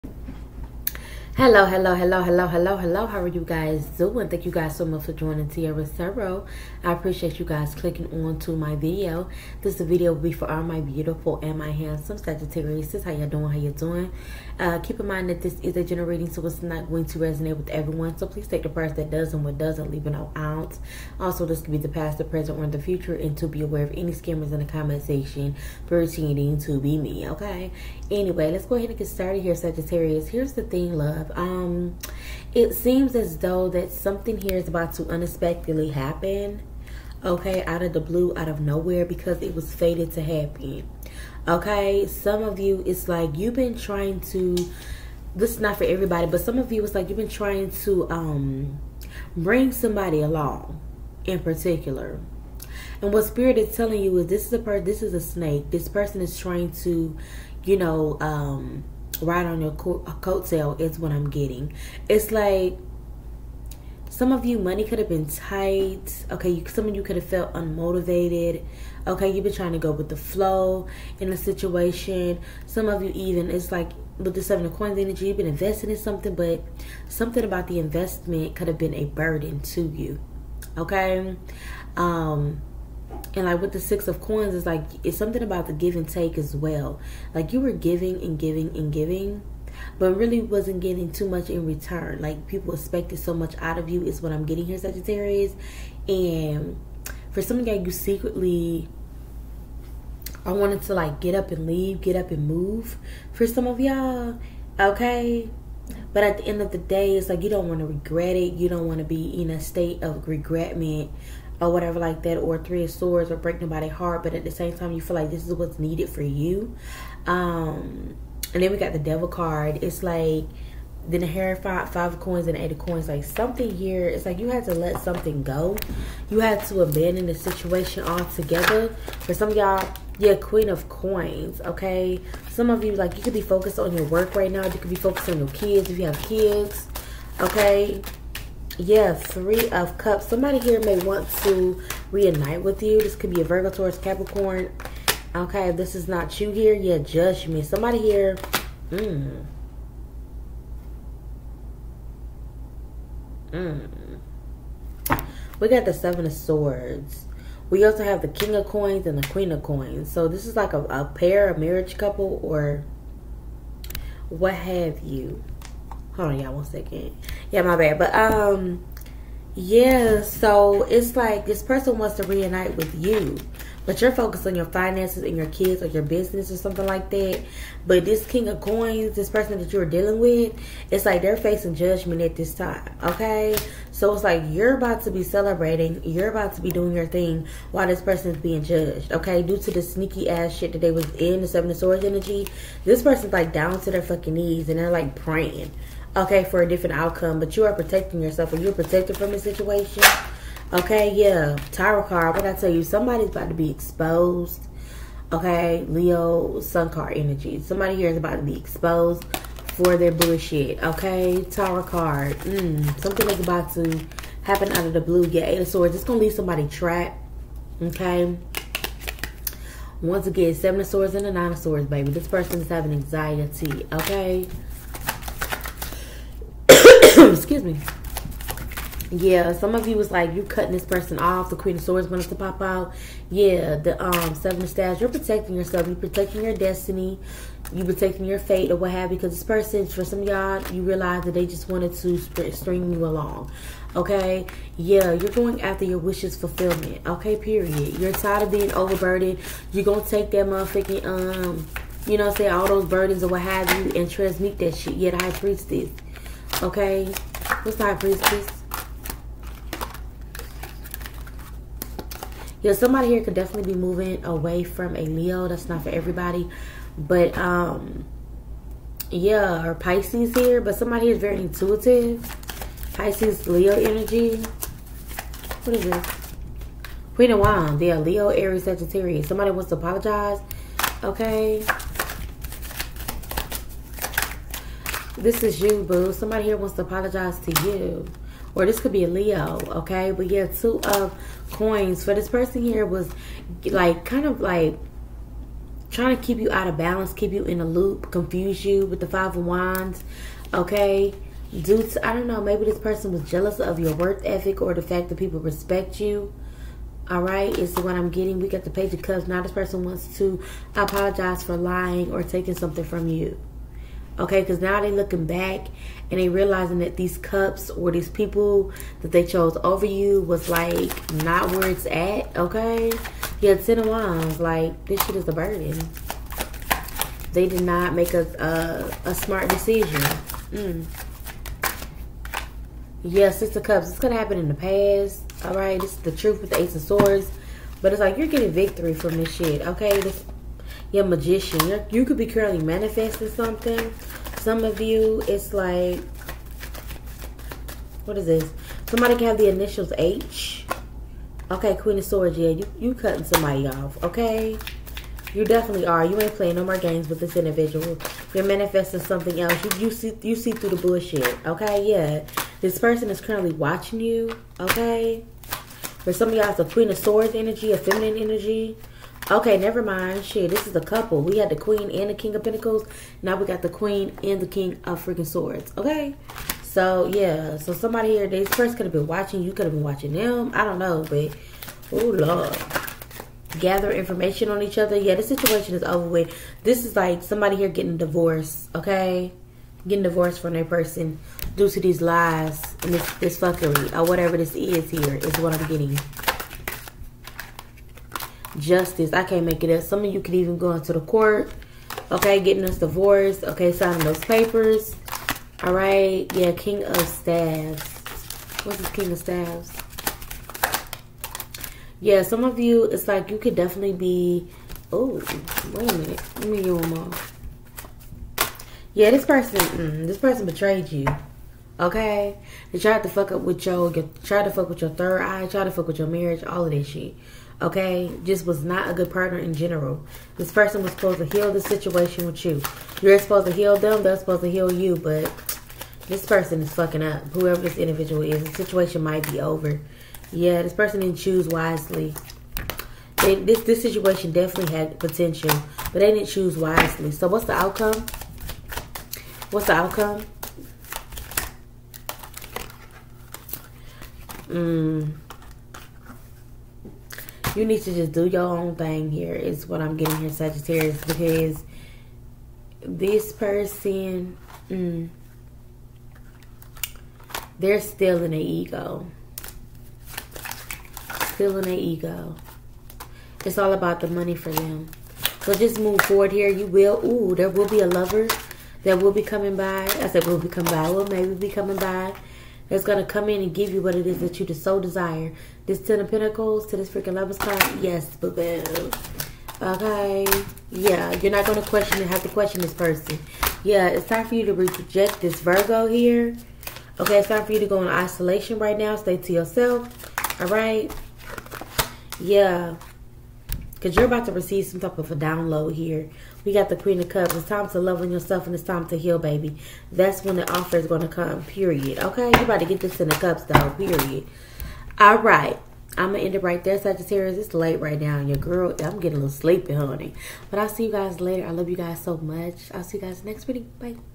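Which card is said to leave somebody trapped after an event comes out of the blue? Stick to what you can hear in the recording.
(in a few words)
Eight of Swords.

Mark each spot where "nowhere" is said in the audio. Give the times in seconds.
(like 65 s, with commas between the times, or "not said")
38 s.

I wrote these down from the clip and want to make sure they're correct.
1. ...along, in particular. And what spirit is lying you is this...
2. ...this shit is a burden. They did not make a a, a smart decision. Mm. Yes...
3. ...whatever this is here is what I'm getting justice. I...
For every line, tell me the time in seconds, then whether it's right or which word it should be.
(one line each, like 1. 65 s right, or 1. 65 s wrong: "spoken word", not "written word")
1. 50 s wrong: "telling", not "lying"
2. 324 s right
3. 394 s right.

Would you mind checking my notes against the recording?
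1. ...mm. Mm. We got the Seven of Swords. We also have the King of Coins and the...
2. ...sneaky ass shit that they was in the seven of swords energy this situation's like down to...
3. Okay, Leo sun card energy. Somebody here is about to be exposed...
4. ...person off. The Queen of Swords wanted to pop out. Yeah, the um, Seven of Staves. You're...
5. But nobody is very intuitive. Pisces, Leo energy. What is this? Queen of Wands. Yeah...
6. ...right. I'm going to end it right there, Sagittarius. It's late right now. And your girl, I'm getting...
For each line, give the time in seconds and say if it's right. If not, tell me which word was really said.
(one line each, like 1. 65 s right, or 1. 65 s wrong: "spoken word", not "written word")
1. 148 s right
2. 189 s wrong: "person", not "situation"
3. 205 s right
4. 230 s right
5. 270 s wrong: "somebody", not "nobody"
6. 515 s right.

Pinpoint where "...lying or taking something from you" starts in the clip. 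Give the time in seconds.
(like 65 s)
311 s.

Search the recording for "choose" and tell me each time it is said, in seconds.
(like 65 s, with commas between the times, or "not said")
441 s, 446 s.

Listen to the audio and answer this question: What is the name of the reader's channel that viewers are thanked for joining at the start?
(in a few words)
Tiara's Tarot.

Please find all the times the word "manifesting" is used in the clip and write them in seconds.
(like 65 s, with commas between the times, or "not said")
342 s, 358 s.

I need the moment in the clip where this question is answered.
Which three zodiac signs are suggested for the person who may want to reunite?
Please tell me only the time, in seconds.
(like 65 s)
143 s.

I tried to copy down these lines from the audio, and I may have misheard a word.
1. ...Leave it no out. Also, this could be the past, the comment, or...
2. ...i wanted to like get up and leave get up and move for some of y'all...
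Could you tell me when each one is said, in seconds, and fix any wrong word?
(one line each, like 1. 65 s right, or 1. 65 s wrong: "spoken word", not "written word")
1. 19 s wrong: "present", not "comment"
2. 100 s right.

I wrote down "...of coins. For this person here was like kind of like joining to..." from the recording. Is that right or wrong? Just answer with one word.
wrong.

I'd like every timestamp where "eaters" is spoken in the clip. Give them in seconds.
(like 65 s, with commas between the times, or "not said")
not said.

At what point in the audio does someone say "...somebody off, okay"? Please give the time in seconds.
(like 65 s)
353 s.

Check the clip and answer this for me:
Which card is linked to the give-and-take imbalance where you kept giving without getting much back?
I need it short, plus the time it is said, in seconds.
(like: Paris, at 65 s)
Six of Coins, at 83 s.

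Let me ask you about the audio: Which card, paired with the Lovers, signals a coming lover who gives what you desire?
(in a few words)
Ten of Pentacles.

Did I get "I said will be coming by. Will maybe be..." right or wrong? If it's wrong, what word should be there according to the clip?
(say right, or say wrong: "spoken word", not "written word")
right.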